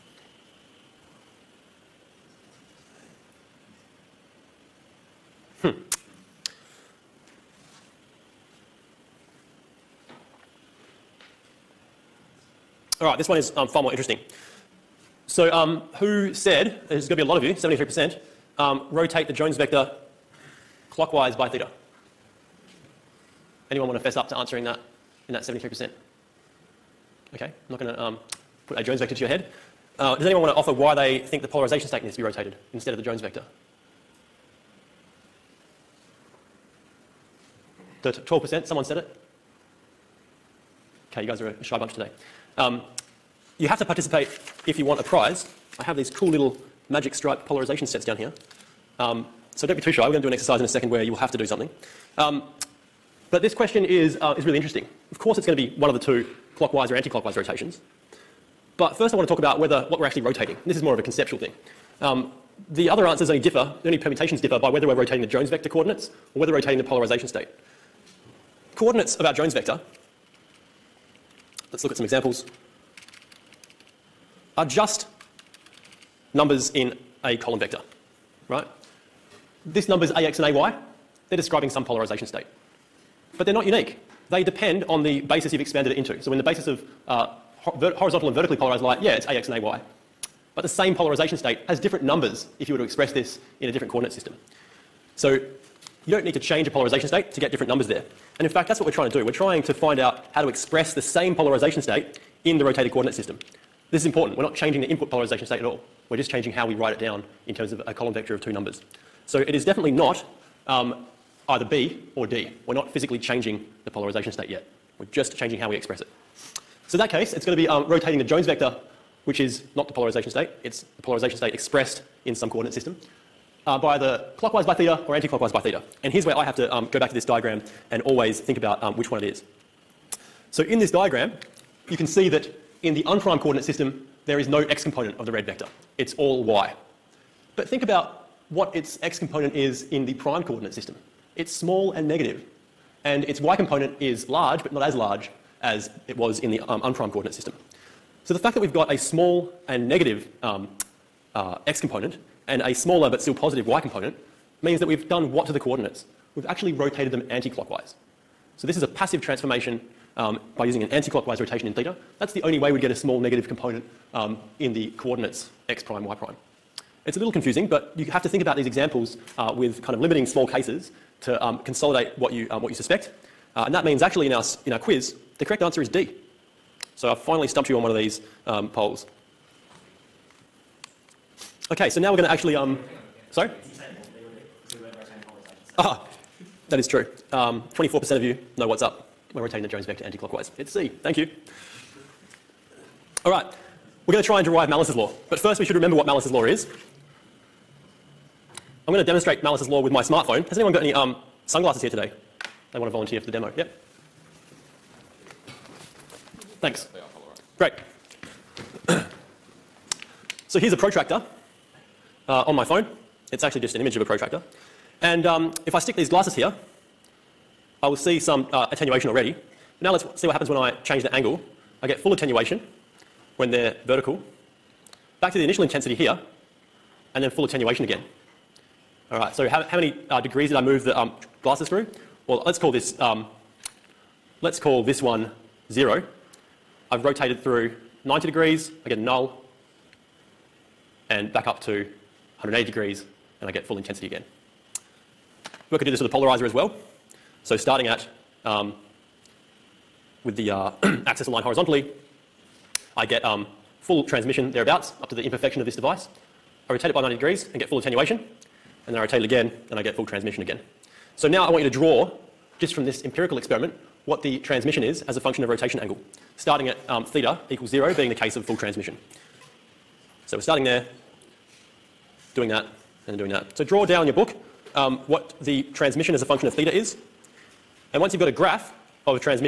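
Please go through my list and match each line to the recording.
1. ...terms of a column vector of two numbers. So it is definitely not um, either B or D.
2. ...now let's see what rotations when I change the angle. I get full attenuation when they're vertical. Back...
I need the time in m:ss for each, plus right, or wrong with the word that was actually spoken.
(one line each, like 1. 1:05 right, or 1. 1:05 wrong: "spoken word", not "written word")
1. 1:47 right
2. 3:39 wrong: "happens", not "rotations".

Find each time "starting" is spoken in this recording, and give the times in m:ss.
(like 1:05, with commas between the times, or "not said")
4:07, 4:26, 4:30.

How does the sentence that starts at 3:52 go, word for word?
Well, let's call this um, Let's call this one 0.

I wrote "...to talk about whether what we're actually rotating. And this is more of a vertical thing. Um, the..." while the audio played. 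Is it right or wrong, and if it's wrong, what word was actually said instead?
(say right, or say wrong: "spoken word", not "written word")
wrong: "conceptual", not "vertical".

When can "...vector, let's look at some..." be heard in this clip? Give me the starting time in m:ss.
1:09.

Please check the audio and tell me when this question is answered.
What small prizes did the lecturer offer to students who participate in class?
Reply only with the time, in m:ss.
0:46.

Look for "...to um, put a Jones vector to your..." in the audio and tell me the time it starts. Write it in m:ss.
0:27.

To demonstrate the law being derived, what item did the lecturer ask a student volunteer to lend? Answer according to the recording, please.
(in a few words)
sunglasses.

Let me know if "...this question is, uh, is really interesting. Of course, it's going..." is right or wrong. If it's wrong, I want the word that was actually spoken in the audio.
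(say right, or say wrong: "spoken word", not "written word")
right.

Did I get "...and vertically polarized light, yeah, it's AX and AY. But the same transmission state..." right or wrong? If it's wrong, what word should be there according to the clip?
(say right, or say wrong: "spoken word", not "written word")
wrong: "polarization", not "transmission".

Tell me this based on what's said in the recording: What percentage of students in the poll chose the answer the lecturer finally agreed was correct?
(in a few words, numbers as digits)
24%.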